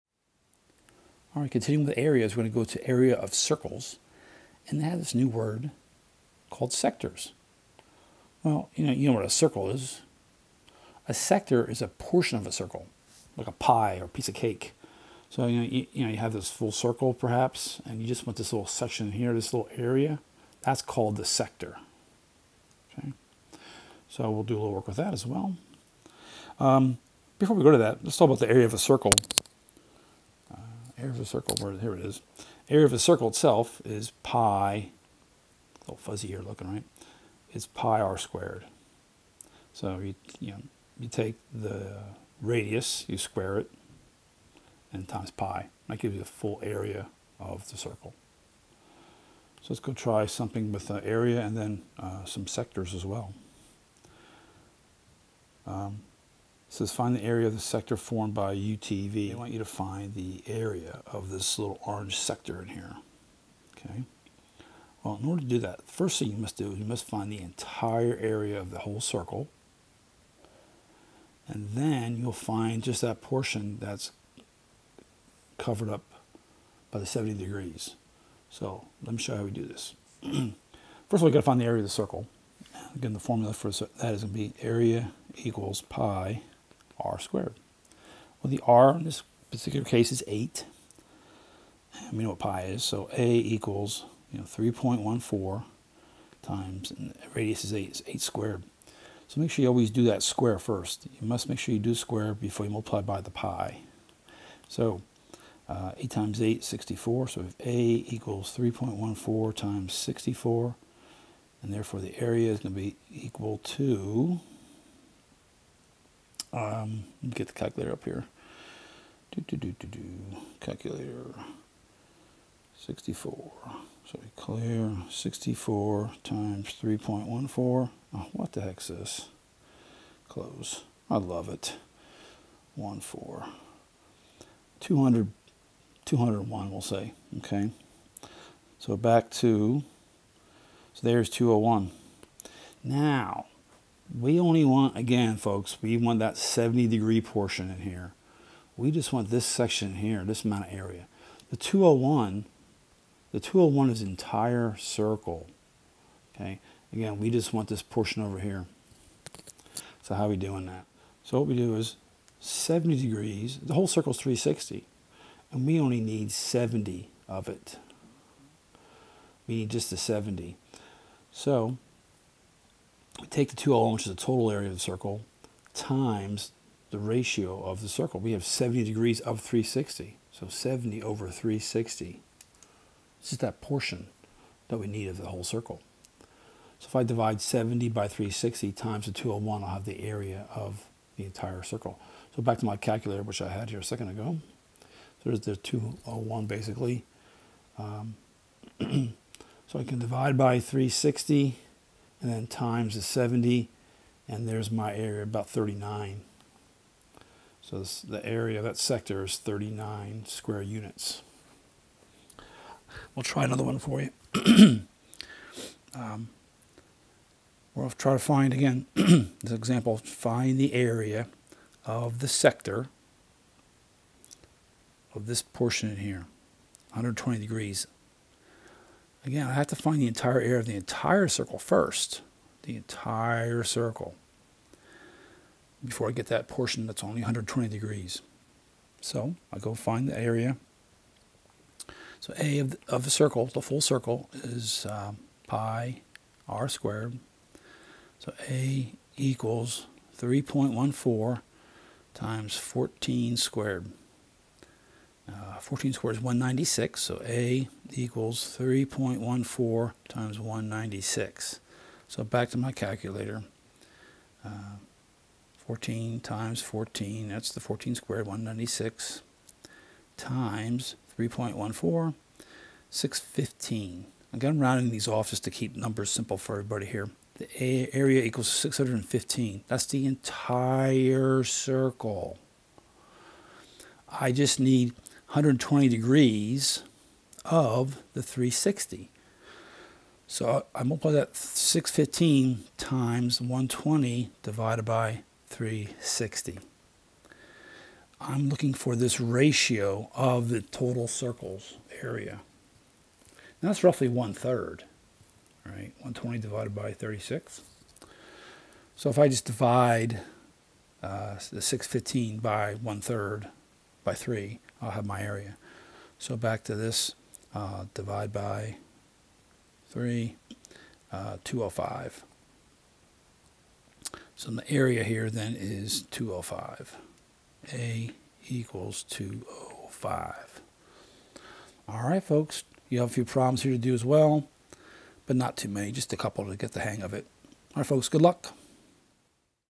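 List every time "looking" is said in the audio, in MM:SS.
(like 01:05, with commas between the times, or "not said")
00:36, 04:58.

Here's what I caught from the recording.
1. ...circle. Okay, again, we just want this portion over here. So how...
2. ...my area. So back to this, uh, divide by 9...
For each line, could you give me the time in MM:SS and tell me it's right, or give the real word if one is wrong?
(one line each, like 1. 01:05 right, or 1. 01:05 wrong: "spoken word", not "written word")
1. 02:34 right
2. 05:15 wrong: "3", not "9".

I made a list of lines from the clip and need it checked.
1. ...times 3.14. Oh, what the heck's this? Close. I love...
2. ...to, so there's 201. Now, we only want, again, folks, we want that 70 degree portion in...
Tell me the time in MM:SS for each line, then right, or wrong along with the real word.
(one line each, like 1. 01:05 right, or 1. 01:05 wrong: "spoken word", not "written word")
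1. 02:06 right
2. 02:19 right.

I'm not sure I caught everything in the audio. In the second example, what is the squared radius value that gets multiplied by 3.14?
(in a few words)
196.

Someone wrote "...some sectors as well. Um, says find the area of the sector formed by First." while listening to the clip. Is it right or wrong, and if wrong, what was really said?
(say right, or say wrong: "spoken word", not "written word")
wrong: "UTV", not "First".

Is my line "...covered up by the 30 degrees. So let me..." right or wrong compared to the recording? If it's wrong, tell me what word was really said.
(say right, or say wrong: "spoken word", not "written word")
wrong: "70", not "30".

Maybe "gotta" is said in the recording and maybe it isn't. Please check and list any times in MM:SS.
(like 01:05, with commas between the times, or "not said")
01:21.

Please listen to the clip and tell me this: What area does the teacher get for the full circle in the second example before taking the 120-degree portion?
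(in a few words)
615.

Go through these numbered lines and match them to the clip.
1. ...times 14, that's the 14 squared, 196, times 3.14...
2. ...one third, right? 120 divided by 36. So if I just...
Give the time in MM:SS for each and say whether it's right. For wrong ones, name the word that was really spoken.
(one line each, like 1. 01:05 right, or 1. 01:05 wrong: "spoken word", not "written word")
1. 04:26 right
2. 05:04 right.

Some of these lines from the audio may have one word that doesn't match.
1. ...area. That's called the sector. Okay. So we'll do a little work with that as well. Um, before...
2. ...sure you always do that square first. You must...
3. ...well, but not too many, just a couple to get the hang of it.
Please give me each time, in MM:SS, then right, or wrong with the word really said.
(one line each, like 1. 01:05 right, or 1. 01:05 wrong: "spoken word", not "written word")
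1. 00:19 right
2. 01:39 right
3. 05:34 right.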